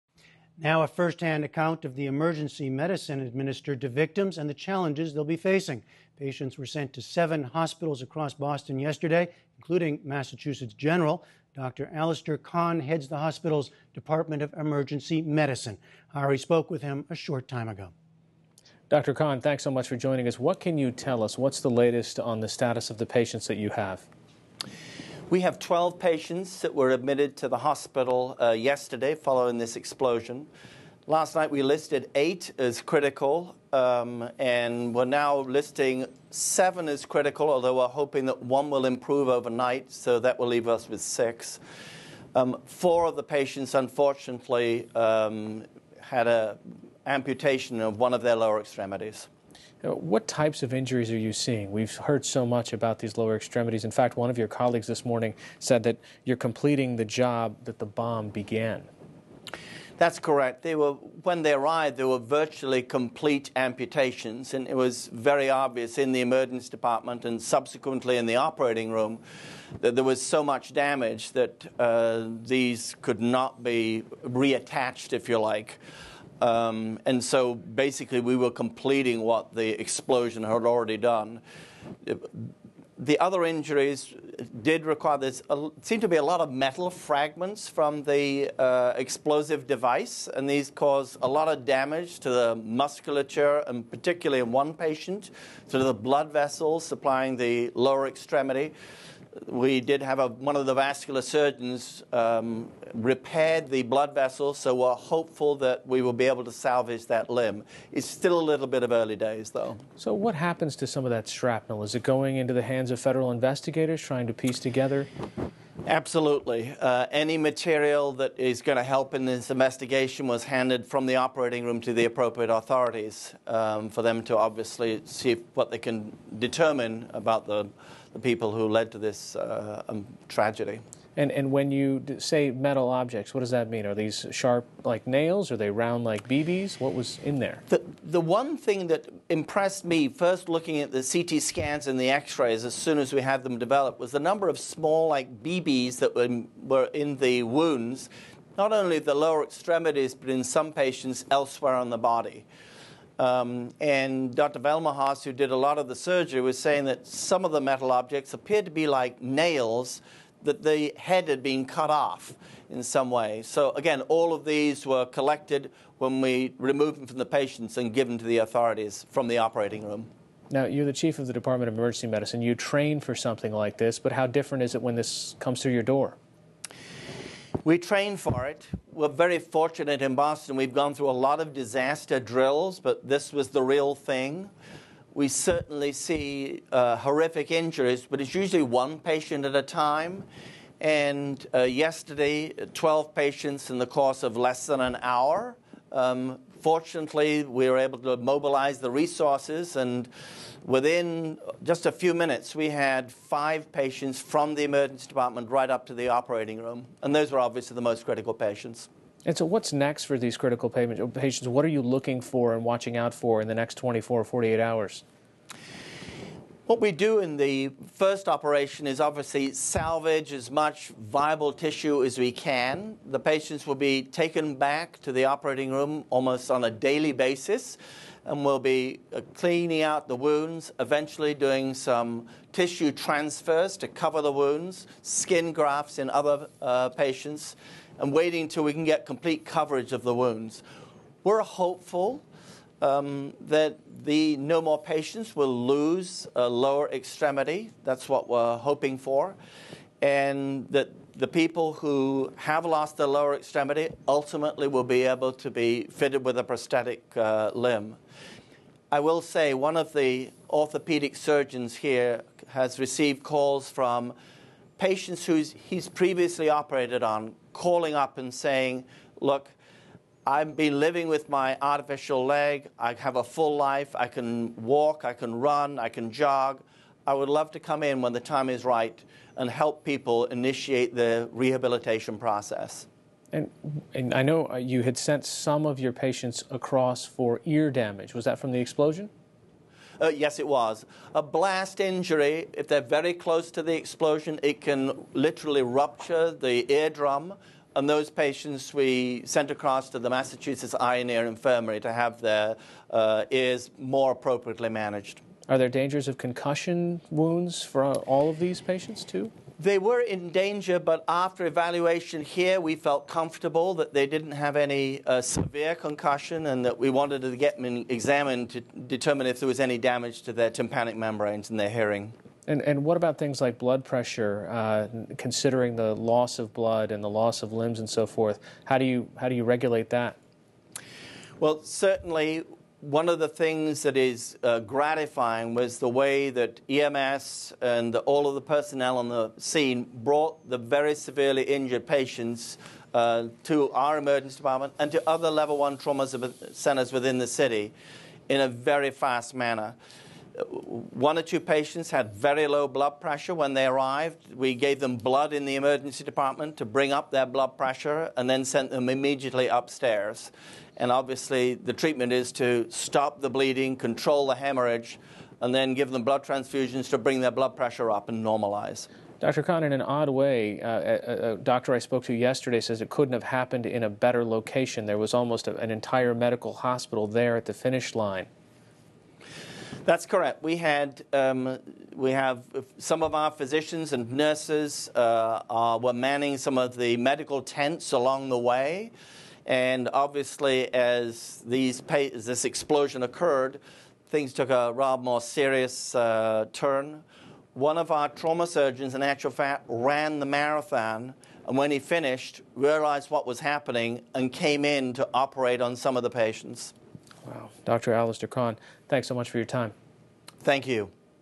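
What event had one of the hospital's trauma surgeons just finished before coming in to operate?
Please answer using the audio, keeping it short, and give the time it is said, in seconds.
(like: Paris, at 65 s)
the marathon, at 400 s.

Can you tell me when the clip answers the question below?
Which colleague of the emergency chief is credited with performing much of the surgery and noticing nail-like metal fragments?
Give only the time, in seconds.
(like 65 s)
154 s.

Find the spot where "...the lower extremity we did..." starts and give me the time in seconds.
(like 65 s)
97 s.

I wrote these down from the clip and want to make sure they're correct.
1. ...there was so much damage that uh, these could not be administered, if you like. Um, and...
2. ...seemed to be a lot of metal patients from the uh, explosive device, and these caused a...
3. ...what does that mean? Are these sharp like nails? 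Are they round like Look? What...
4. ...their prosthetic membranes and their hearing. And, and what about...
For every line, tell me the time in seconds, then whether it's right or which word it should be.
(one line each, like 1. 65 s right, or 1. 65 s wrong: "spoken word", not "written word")
1. 69 s wrong: "reattached", not "administered"
2. 85 s wrong: "fragments", not "patients"
3. 133 s wrong: "BBs", not "Look"
4. 320 s wrong: "tympanic", not "prosthetic".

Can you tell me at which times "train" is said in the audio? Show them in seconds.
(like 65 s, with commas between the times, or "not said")
172 s, 177 s.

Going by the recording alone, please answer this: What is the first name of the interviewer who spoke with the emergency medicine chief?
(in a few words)
Hari.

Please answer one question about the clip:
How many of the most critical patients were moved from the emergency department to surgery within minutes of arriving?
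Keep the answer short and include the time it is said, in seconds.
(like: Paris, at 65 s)
5, at 203 s.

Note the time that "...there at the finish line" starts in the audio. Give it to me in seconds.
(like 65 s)
377 s.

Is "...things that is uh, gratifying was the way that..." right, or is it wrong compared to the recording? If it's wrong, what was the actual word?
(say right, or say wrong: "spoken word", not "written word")
right.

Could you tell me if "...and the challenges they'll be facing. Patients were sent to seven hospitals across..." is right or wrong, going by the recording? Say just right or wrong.
right.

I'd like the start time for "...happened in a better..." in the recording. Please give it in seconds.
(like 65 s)
373 s.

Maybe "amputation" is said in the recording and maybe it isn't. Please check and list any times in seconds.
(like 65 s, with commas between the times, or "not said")
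47 s, 63 s.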